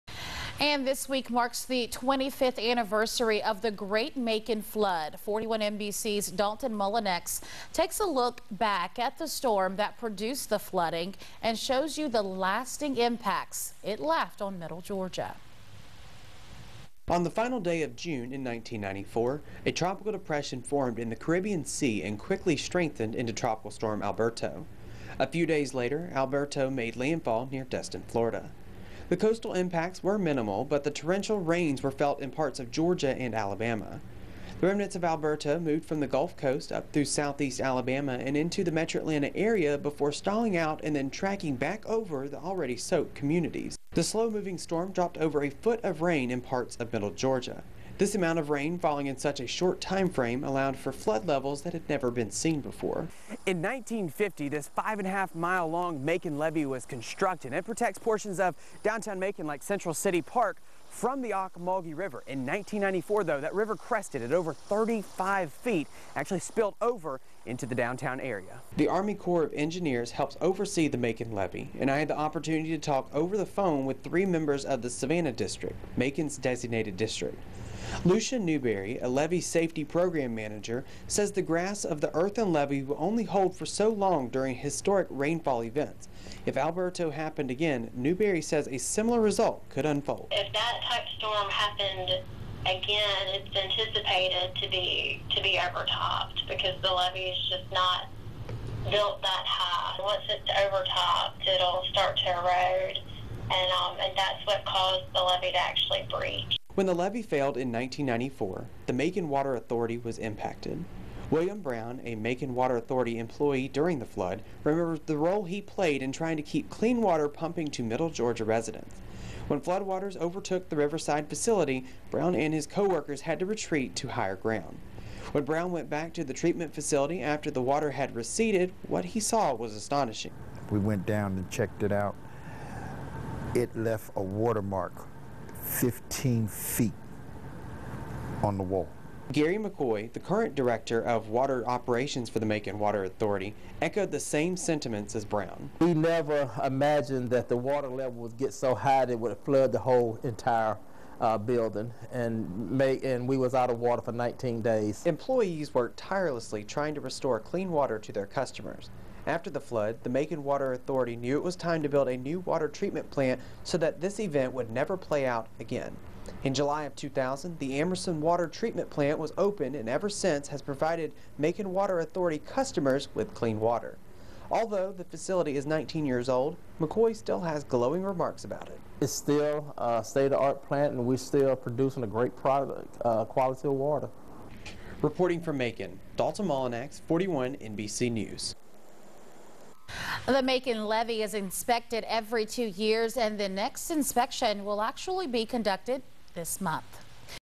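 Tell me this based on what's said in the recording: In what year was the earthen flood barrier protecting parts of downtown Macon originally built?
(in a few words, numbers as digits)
1950.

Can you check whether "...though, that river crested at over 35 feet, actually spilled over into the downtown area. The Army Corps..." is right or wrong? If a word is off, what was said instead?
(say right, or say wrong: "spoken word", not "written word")
right.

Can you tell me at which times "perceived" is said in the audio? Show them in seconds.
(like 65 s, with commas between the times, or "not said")
not said.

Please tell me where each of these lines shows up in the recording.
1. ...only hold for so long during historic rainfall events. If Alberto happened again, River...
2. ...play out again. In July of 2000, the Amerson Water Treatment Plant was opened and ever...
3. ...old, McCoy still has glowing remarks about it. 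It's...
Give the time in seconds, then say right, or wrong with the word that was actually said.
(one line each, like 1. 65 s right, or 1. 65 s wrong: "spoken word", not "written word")
1. 82 s wrong: "Newberry", not "River"
2. 164 s right
3. 176 s right.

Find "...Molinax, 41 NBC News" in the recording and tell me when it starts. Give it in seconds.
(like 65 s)
186 s.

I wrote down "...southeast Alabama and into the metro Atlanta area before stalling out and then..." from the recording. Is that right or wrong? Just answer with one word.
right.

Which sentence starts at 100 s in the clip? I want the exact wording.
Once it's overtopped, it'll start to erode, and um, and that's what caused the levee to actually breach.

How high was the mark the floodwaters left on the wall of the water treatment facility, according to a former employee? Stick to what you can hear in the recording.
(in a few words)
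15 feet.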